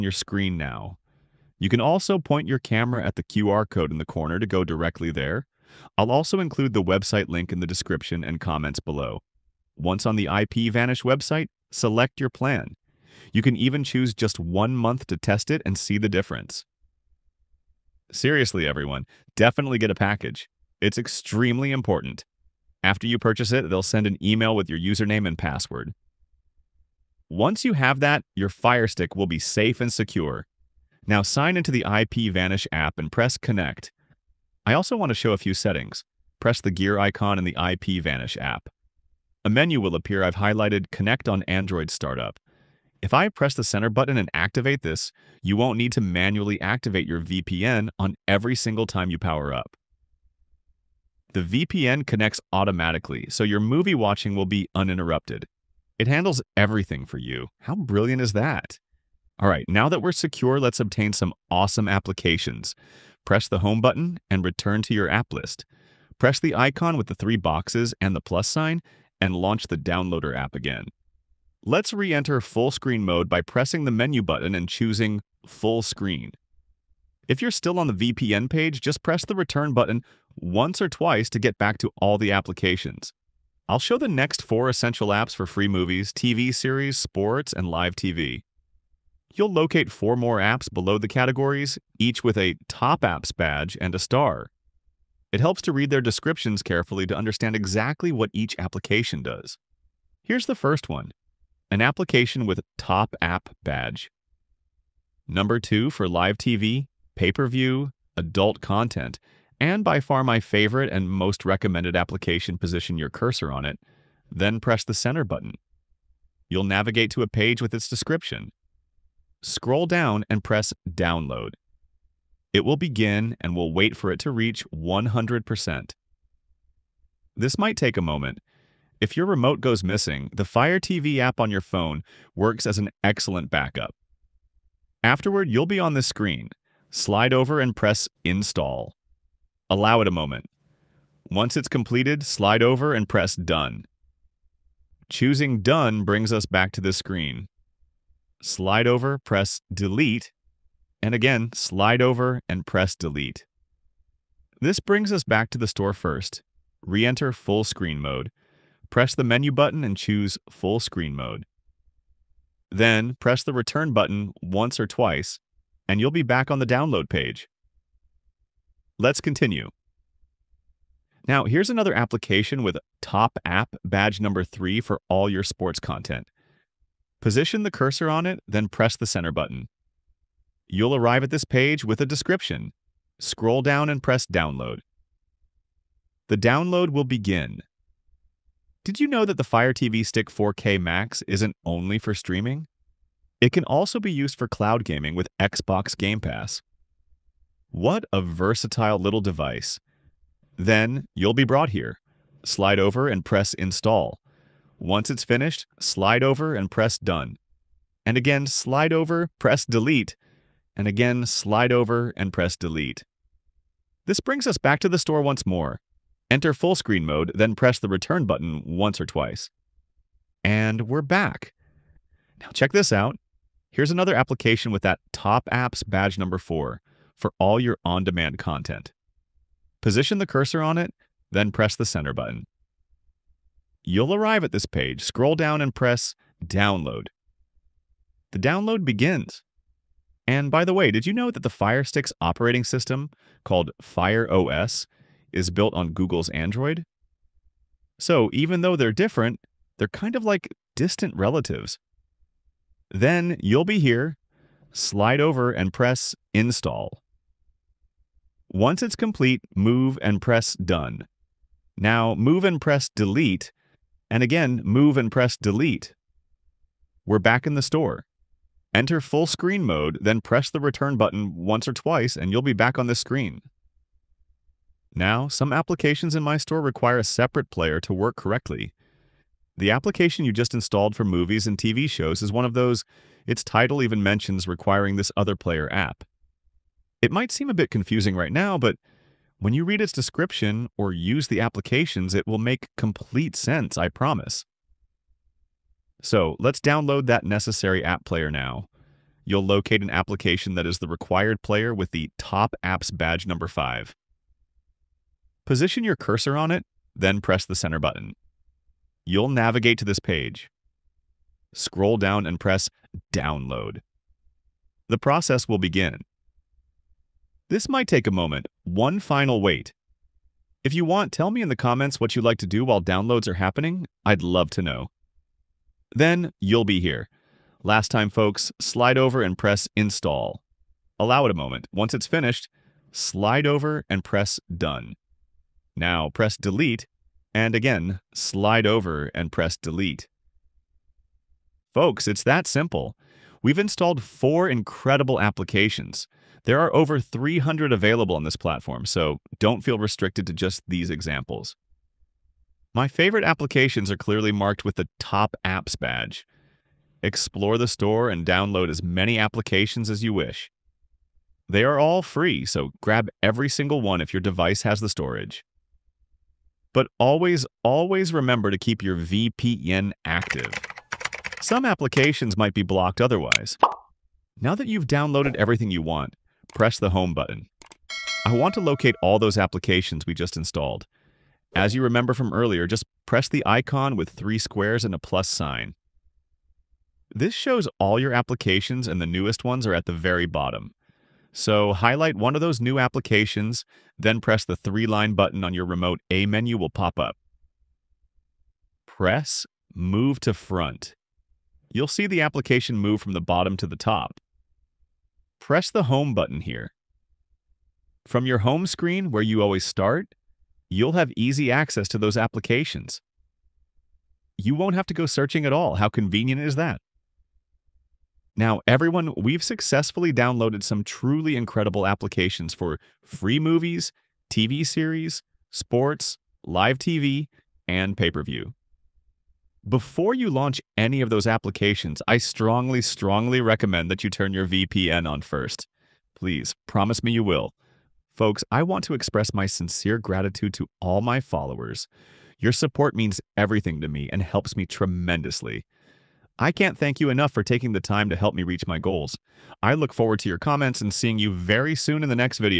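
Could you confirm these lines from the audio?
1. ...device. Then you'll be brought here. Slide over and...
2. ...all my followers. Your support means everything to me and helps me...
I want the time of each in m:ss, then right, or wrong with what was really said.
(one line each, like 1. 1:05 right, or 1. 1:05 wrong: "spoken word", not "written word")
1. 3:19 right
2. 7:20 right.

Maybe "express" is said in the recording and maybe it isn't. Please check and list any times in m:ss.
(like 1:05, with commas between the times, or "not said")
7:18.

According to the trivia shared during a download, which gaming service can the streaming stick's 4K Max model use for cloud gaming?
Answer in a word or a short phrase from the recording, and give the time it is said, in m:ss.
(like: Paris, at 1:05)
Xbox Game Pass, at 3:15.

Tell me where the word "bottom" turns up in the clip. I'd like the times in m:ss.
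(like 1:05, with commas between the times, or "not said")
6:30, 6:43.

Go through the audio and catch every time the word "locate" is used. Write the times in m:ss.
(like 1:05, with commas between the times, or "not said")
1:29, 4:59, 6:18.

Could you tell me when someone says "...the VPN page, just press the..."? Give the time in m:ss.
1:17.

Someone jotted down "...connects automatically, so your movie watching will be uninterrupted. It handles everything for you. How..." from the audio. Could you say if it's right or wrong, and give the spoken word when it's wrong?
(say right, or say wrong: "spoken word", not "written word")
right.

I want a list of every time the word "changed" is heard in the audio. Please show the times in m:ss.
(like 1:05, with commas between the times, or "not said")
not said.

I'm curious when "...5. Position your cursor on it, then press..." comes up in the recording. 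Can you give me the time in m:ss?
5:03.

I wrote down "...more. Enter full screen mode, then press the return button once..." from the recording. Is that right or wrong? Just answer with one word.
right.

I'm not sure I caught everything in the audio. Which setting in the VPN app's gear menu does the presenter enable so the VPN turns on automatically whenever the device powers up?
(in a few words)
Connect on Android Startup.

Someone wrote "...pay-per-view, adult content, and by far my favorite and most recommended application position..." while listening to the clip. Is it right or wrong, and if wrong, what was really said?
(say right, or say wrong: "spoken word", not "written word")
right.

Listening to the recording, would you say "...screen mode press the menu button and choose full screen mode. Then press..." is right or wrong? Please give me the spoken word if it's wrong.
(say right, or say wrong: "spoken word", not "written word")
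right.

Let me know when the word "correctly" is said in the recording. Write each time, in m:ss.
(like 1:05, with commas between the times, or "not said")
4:38.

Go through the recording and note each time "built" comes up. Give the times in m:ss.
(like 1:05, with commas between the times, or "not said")
4:05.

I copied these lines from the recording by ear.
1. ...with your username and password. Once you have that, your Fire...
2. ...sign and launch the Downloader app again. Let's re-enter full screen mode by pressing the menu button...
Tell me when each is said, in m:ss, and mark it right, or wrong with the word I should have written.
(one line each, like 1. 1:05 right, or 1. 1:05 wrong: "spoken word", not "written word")
1. 0:24 right
2. 1:08 right.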